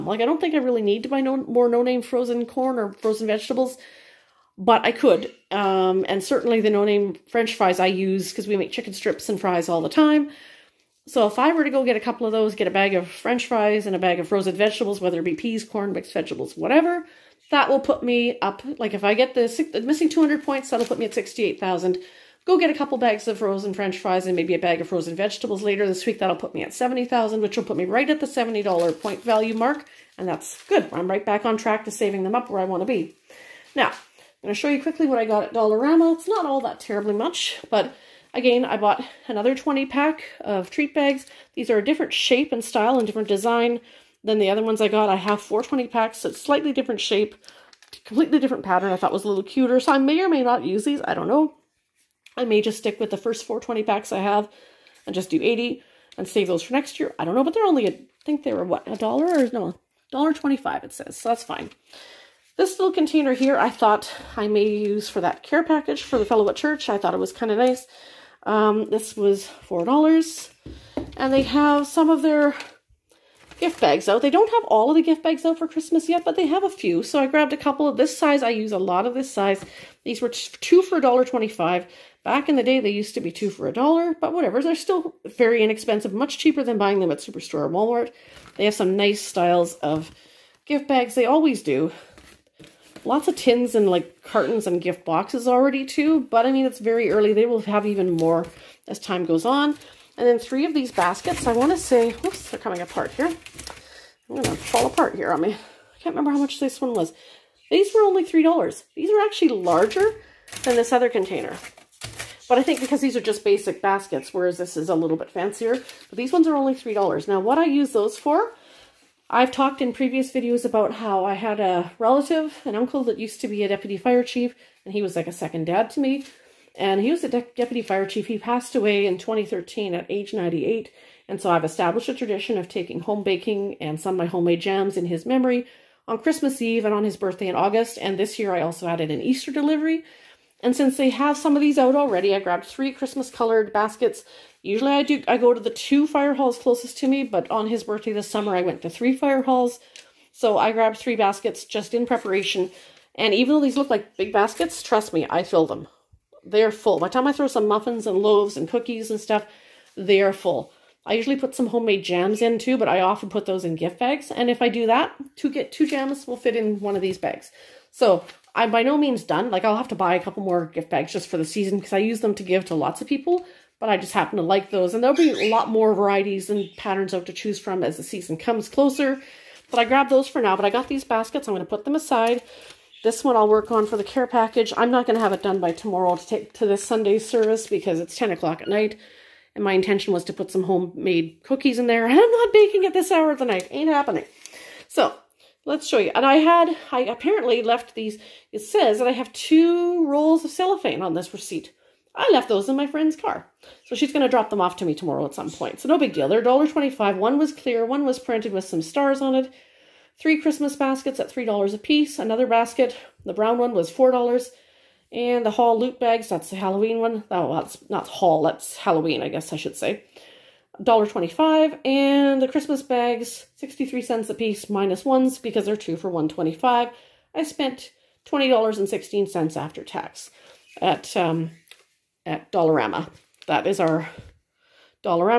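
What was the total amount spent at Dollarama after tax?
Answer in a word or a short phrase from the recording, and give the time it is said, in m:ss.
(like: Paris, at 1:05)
$20.16, at 3:48.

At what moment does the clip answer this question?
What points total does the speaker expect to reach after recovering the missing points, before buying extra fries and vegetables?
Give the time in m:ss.
0:21.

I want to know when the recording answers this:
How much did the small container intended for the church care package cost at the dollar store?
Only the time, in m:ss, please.
1:08.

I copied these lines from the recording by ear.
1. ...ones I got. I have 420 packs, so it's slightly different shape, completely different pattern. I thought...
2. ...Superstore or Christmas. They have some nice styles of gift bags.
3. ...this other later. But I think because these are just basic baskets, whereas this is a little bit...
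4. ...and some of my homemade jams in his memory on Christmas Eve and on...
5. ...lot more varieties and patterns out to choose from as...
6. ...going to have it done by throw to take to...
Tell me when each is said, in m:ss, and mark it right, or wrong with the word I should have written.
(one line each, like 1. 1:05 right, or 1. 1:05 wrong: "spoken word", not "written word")
1. 0:44 right
2. 1:27 wrong: "Walmart", not "Christmas"
3. 1:50 wrong: "container", not "later"
4. 2:13 right
5. 2:55 right
6. 3:05 wrong: "tomorrow", not "throw".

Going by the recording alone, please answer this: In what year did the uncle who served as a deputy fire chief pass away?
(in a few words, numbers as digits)
2013.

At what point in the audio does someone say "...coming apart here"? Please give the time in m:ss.
1:42.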